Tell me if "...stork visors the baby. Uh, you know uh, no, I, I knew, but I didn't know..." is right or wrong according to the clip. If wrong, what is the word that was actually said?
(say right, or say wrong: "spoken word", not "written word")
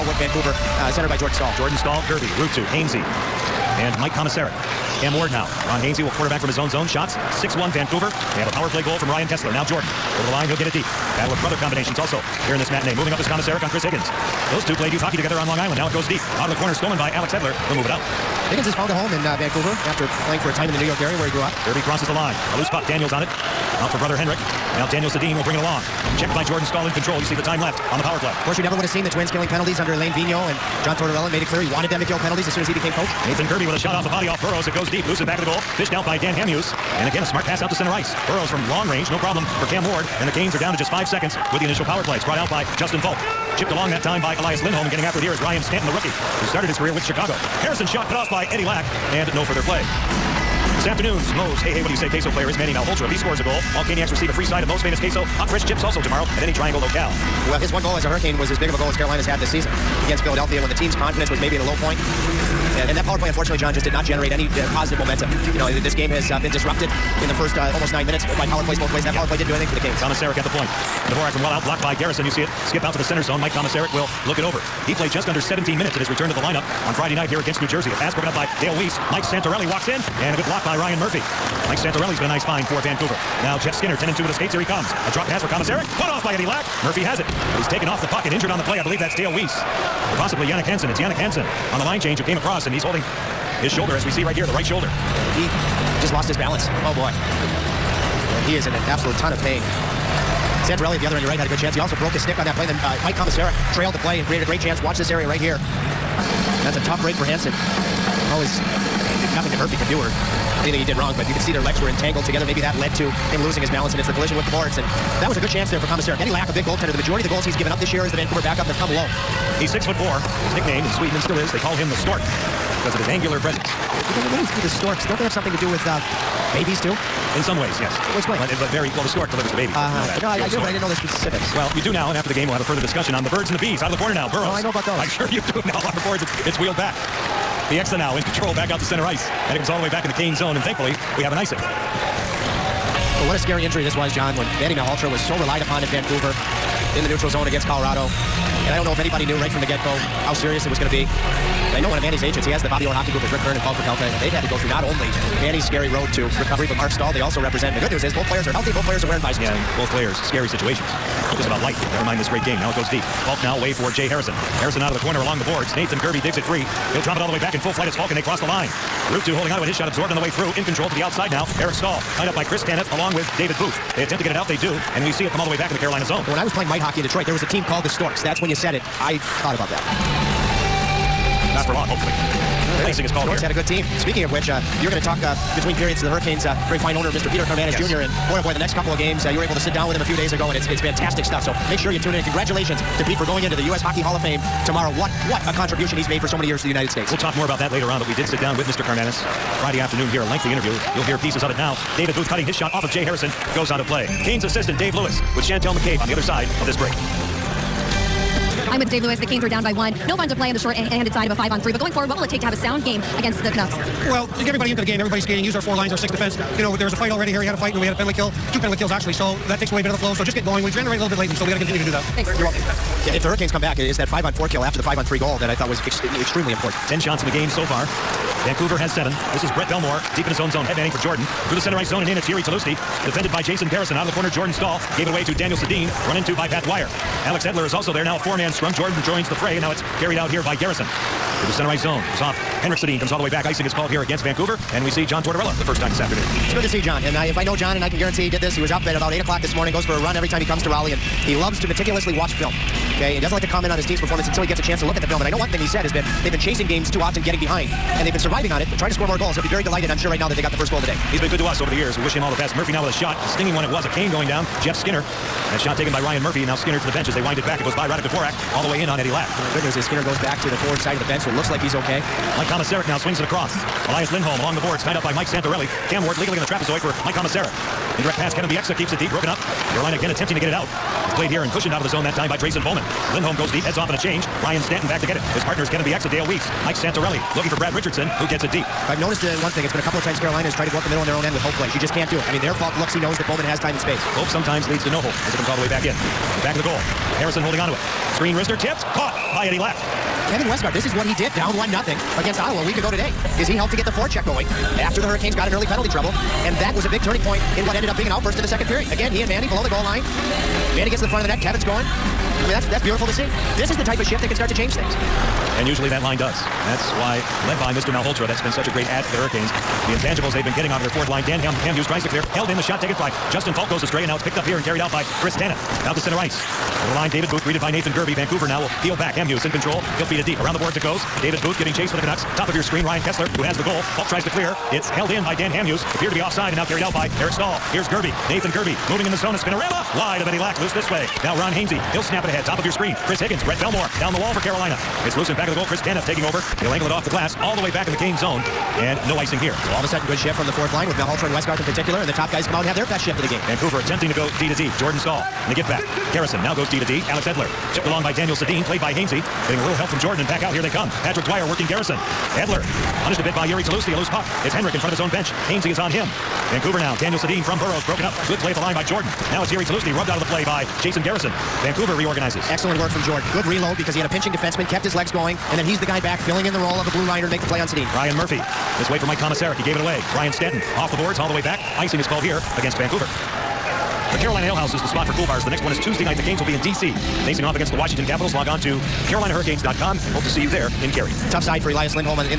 wrong: "delivers", not "visors".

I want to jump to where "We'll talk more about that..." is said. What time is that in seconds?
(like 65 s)
197 s.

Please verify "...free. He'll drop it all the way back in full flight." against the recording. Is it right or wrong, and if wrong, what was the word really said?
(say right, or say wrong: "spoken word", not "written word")
right.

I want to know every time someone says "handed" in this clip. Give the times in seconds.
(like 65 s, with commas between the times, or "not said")
210 s.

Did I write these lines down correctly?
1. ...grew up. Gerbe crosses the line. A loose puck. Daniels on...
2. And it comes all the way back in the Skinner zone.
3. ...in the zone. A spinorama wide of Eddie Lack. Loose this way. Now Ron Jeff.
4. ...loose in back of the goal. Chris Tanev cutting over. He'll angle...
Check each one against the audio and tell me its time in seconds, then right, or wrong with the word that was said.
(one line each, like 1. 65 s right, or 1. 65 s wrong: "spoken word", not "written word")
1. 21 s right
2. 139 s wrong: "Kane", not "Skinner"
3. 339 s wrong: "Hainsey", not "Jeff"
4. 345 s wrong: "taking", not "cutting".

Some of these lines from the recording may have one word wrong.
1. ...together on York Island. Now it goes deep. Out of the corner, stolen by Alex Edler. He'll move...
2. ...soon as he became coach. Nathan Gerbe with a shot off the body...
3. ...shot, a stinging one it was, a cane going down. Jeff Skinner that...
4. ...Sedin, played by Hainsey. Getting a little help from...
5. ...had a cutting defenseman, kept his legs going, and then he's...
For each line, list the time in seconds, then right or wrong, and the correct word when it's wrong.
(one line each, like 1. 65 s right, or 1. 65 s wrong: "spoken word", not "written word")
1. 15 s wrong: "Long", not "York"
2. 32 s right
3. 262 s right
4. 358 s right
5. 373 s wrong: "pinching", not "cutting".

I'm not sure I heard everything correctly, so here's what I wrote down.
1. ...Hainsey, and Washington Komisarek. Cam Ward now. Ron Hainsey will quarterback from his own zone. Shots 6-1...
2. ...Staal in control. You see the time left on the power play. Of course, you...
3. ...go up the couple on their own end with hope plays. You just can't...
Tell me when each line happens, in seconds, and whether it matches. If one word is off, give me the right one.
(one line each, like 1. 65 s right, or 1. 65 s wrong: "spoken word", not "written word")
1. 2 s wrong: "Mike", not "Washington"
2. 26 s right
3. 290 s wrong: "middle", not "couple".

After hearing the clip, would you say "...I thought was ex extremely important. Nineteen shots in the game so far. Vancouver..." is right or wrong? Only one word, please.
wrong.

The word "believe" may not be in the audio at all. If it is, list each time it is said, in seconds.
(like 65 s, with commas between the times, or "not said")
88 s.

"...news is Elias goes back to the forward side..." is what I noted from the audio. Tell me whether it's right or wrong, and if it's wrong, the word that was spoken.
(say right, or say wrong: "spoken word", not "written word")
wrong: "Skinner", not "Elias".